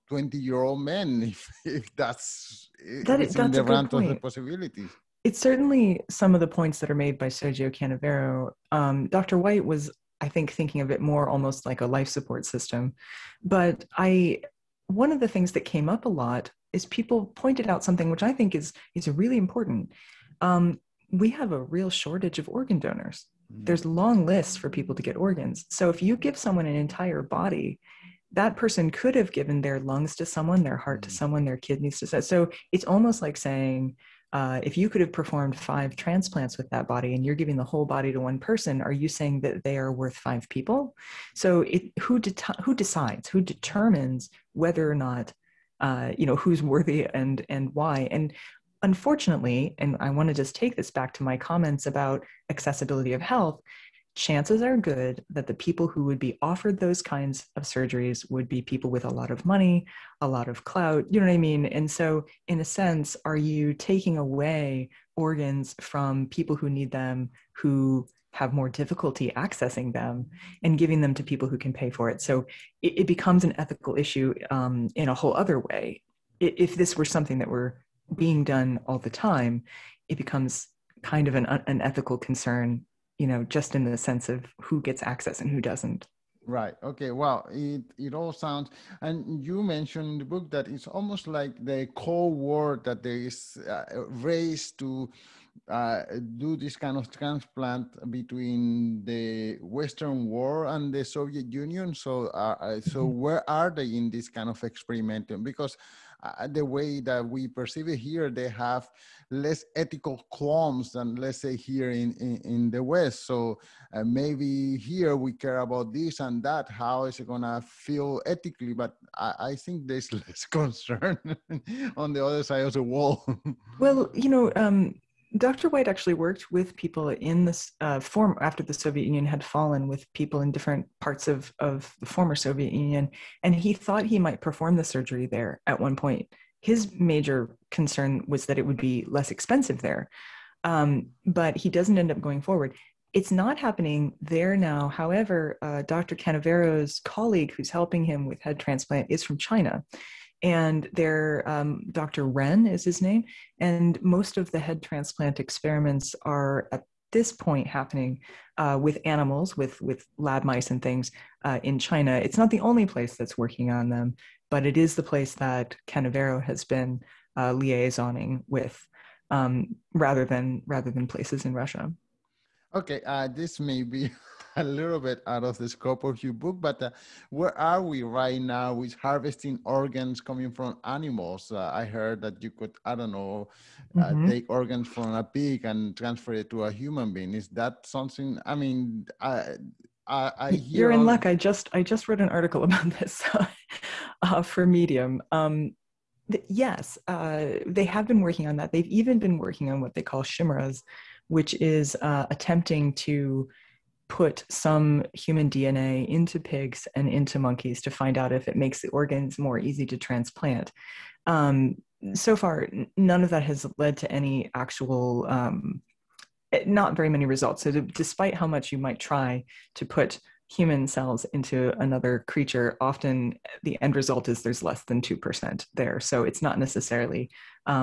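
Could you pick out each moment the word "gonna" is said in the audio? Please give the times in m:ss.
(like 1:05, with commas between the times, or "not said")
1:57.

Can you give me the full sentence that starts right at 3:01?
Uh, I heard that you could, I don't know, uh, mm-hmm.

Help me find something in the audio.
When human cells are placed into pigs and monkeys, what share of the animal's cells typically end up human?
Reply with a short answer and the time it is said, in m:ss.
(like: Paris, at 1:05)
less than 2 percent, at 3:44.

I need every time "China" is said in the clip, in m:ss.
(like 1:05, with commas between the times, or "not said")
2:29, 2:41.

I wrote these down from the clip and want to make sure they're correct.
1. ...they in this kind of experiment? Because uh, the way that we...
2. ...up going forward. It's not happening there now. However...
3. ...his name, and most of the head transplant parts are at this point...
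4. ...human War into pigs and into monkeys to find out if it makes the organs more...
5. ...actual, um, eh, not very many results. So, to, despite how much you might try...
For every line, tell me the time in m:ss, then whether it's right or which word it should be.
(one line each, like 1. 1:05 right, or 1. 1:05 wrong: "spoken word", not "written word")
1. 1:43 right
2. 2:22 right
3. 2:32 wrong: "experiments", not "parts"
4. 3:25 wrong: "DNA", not "War"
5. 3:34 right.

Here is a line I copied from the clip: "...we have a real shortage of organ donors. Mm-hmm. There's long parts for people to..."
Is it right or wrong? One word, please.
wrong.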